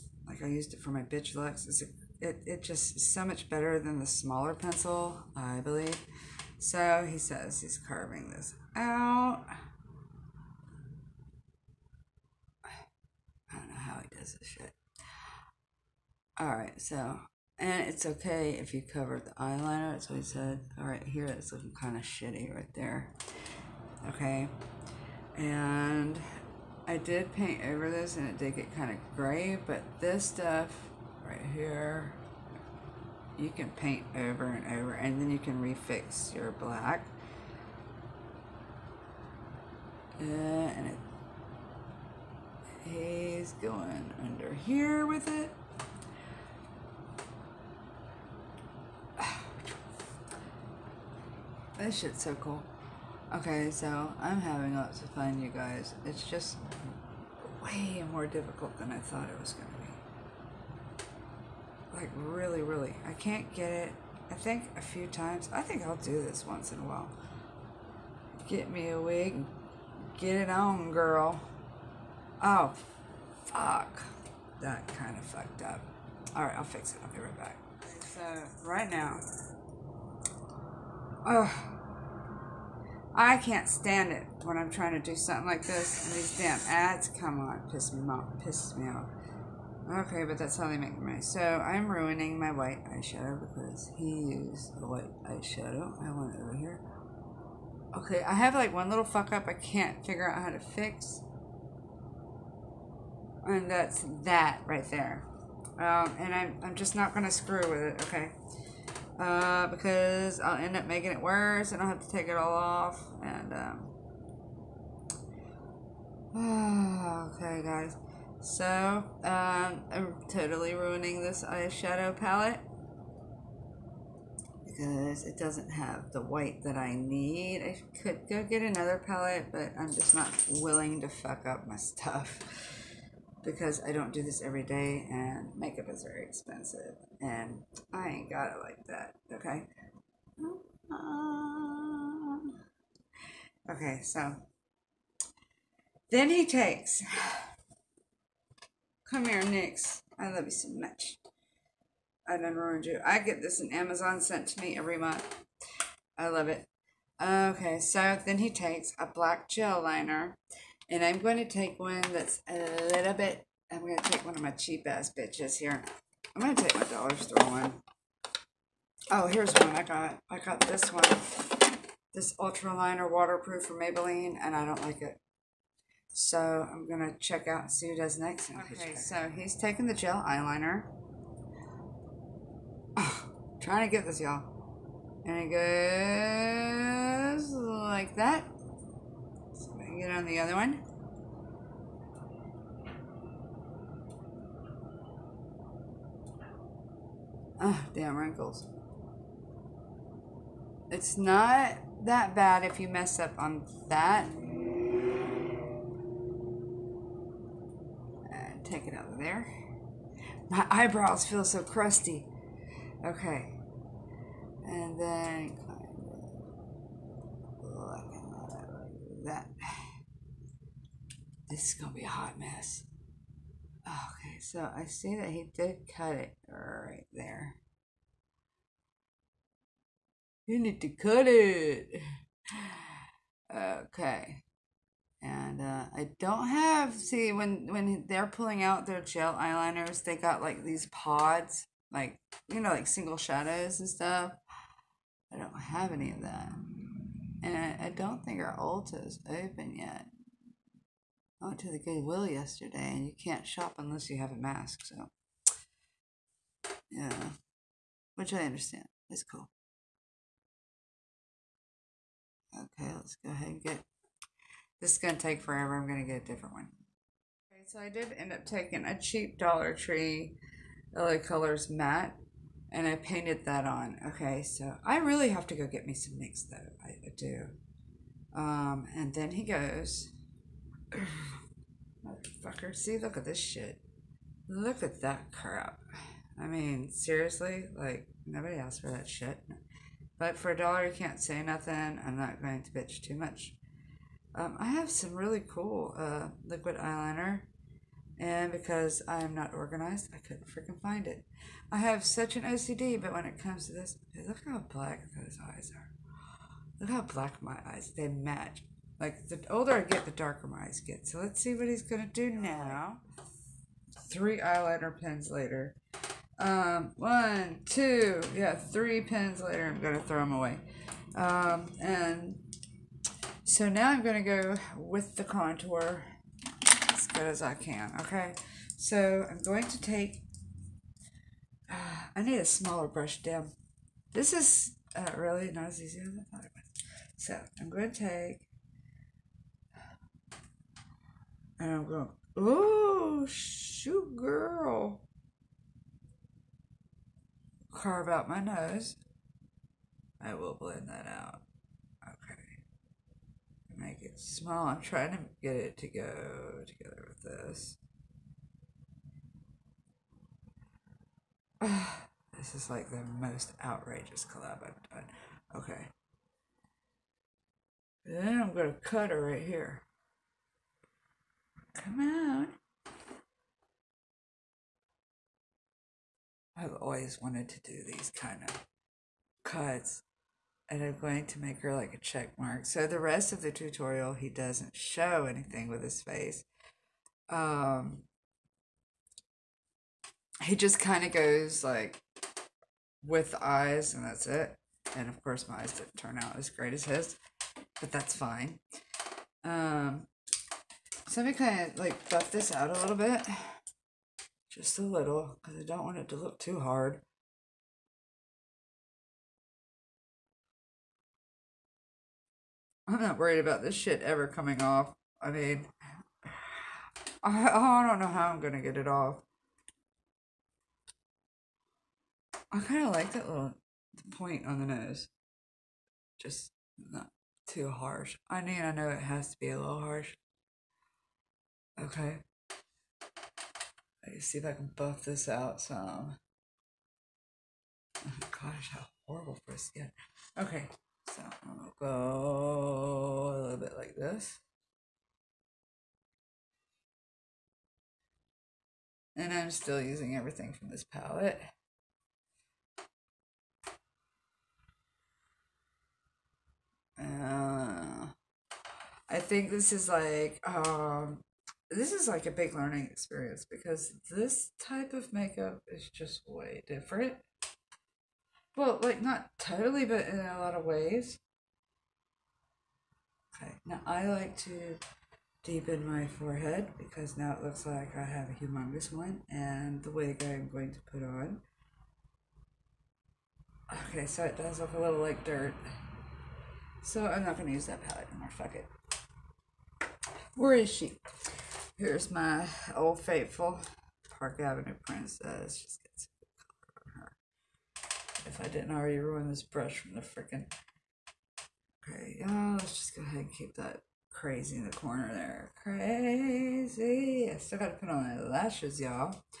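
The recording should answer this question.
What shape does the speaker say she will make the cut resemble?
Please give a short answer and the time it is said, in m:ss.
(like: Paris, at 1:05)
a check mark, at 6:21.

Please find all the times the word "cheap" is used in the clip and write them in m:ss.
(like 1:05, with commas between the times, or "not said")
2:44, 4:29.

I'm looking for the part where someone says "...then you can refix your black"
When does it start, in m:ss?
0:35.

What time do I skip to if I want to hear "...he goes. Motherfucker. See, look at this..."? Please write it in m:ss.
4:39.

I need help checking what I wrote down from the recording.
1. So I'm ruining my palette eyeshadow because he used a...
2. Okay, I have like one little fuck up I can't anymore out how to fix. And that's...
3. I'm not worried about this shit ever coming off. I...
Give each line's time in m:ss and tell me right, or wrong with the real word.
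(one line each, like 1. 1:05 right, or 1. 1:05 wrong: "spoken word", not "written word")
1. 1:31 wrong: "white", not "palette"
2. 1:37 wrong: "figure", not "anymore"
3. 6:52 right.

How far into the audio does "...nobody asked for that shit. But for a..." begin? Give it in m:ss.
4:48.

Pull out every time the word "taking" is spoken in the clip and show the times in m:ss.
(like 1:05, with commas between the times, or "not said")
2:59, 4:28.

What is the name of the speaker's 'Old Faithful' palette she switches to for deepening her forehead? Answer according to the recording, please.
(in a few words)
Park Avenue Princess.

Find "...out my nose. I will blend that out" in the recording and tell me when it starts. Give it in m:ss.
5:48.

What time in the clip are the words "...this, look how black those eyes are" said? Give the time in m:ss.
5:03.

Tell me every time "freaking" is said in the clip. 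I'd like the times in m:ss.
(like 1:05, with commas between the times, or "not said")
5:00, 8:20.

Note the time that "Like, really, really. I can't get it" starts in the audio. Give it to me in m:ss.
1:01.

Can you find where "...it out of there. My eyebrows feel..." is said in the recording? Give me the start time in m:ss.
3:28.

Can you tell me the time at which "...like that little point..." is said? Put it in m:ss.
7:02.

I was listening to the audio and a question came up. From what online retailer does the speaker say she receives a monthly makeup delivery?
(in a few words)
Amazon.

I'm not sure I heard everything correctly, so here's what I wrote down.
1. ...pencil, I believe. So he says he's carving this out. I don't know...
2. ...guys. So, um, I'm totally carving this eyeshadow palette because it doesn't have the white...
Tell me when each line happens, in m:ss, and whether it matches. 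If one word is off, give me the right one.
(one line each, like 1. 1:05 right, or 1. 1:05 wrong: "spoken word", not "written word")
1. 0:04 right
2. 1:57 wrong: "ruining", not "carving".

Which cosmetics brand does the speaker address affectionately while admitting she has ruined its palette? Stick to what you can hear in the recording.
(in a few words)
NYX.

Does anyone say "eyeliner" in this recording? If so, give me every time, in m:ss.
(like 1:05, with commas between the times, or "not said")
0:19, 3:00, 3:59, 4:56, 5:14.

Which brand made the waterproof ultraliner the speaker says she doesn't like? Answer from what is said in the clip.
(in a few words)
Maybelline.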